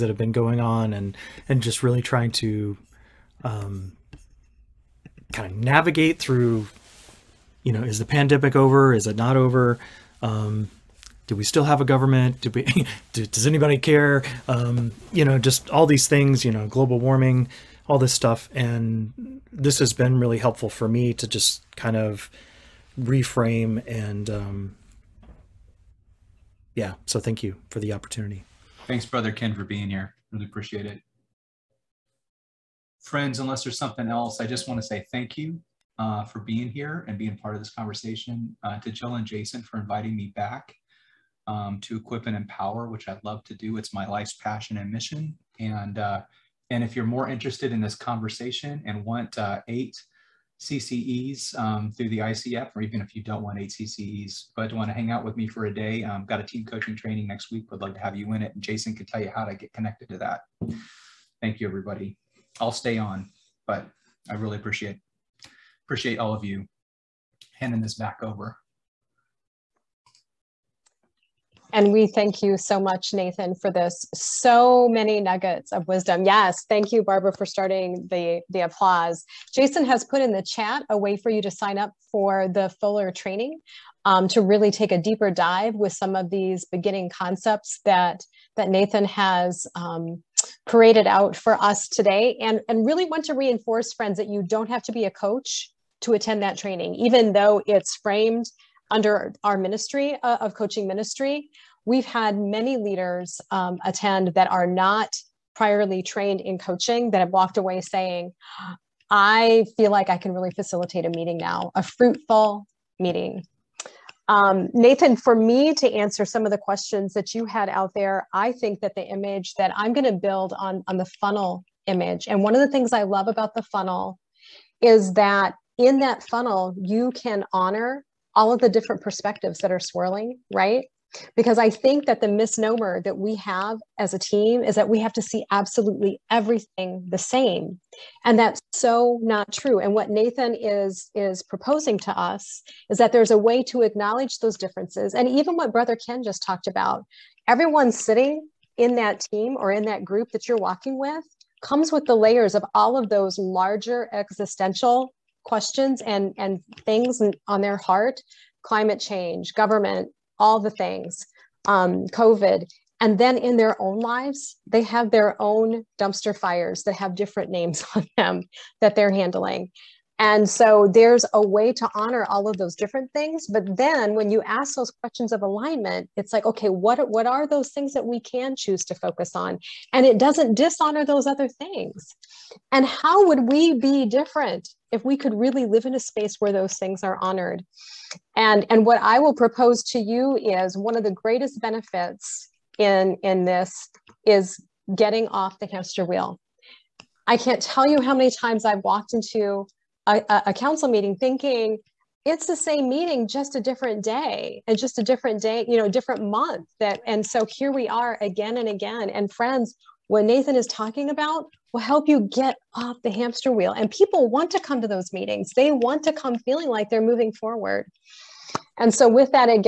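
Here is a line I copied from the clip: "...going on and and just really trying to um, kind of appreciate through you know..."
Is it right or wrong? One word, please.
wrong.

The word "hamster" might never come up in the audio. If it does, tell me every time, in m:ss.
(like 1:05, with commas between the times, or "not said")
3:15, 3:33.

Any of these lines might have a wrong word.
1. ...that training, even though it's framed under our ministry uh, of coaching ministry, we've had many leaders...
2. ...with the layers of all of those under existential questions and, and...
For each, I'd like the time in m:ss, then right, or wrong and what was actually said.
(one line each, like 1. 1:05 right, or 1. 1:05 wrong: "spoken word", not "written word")
1. 1:36 right
2. 2:31 wrong: "larger", not "under".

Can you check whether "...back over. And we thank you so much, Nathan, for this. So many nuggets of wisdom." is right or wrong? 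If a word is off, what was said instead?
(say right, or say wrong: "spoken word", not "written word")
right.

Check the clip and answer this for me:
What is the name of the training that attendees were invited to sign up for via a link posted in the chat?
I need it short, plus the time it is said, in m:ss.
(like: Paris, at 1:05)
Fuller training, at 1:22.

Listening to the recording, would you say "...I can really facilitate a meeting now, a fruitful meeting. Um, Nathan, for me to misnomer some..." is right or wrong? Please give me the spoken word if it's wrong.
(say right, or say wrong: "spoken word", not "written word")
wrong: "answer", not "misnomer".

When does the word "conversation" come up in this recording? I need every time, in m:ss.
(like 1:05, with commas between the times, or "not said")
0:37, 0:47.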